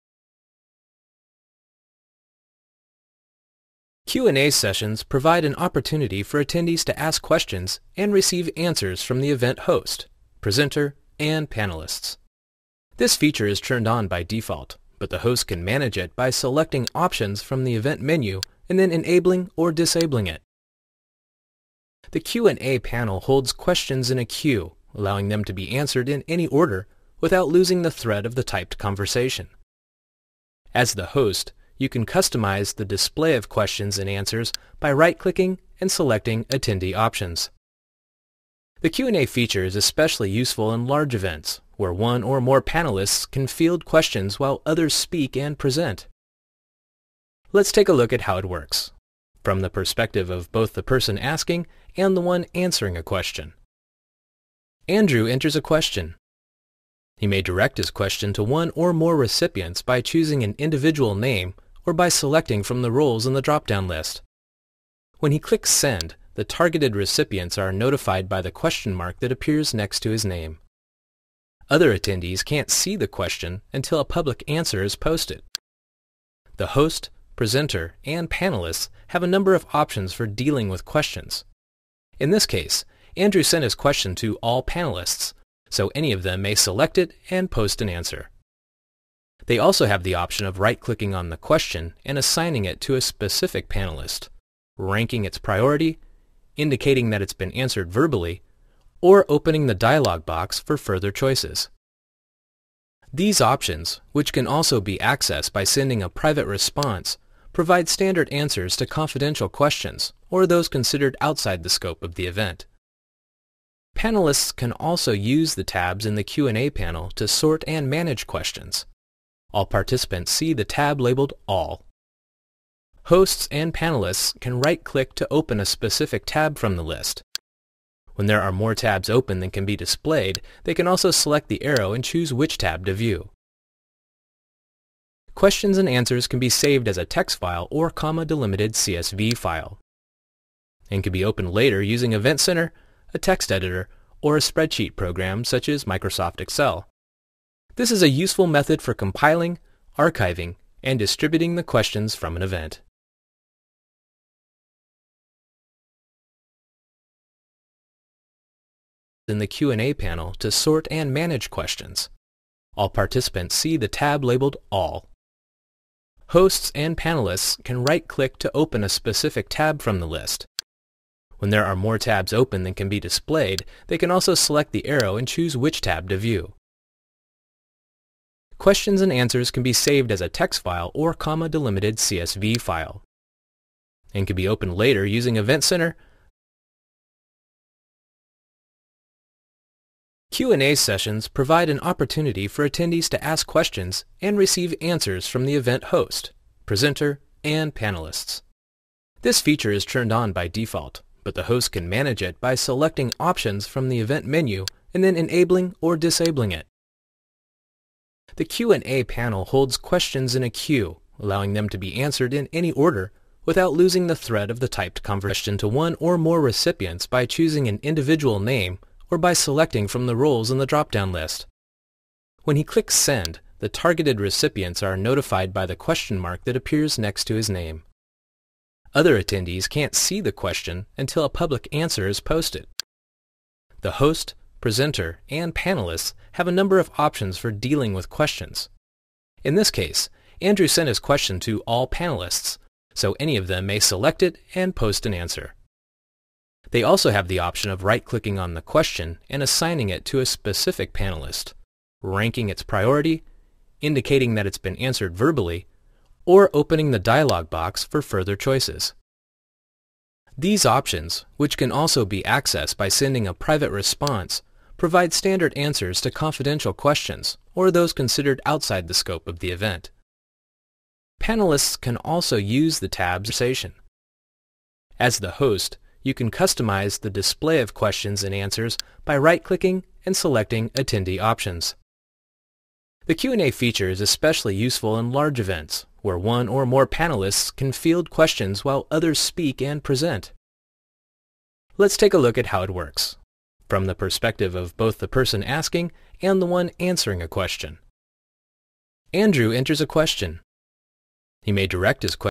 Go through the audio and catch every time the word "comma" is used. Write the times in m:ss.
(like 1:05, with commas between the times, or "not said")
2:17, 3:01.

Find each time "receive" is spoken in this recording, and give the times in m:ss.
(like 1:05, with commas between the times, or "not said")
0:08, 3:14.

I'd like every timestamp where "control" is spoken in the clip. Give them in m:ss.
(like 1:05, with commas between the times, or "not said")
not said.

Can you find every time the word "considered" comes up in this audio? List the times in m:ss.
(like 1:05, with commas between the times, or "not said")
1:50, 4:27.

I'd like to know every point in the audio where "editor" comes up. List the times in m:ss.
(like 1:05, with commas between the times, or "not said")
2:23.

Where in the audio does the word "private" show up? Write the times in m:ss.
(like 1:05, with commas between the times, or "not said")
1:46, 4:23.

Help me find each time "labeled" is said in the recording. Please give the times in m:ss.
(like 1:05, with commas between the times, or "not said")
2:01, 2:44.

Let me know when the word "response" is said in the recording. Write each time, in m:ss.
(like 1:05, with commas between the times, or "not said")
1:46, 4:23.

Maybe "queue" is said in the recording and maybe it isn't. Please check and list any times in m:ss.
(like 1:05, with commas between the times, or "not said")
0:24, 3:30.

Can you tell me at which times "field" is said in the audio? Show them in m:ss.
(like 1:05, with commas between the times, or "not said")
0:43, 4:47.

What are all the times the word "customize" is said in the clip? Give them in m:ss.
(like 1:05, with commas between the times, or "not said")
0:32, 4:36.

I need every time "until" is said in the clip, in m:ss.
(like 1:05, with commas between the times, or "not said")
1:13, 3:50.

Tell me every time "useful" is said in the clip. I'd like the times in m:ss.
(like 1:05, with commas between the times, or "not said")
0:40, 2:28, 4:44.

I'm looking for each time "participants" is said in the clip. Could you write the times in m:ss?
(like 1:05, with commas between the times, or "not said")
1:59, 2:42.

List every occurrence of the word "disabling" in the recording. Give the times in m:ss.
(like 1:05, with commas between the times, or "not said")
0:19, 3:25.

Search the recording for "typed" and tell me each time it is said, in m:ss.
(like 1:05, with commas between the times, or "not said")
0:28, 3:34.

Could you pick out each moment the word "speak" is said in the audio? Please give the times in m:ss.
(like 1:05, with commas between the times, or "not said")
0:44, 4:49.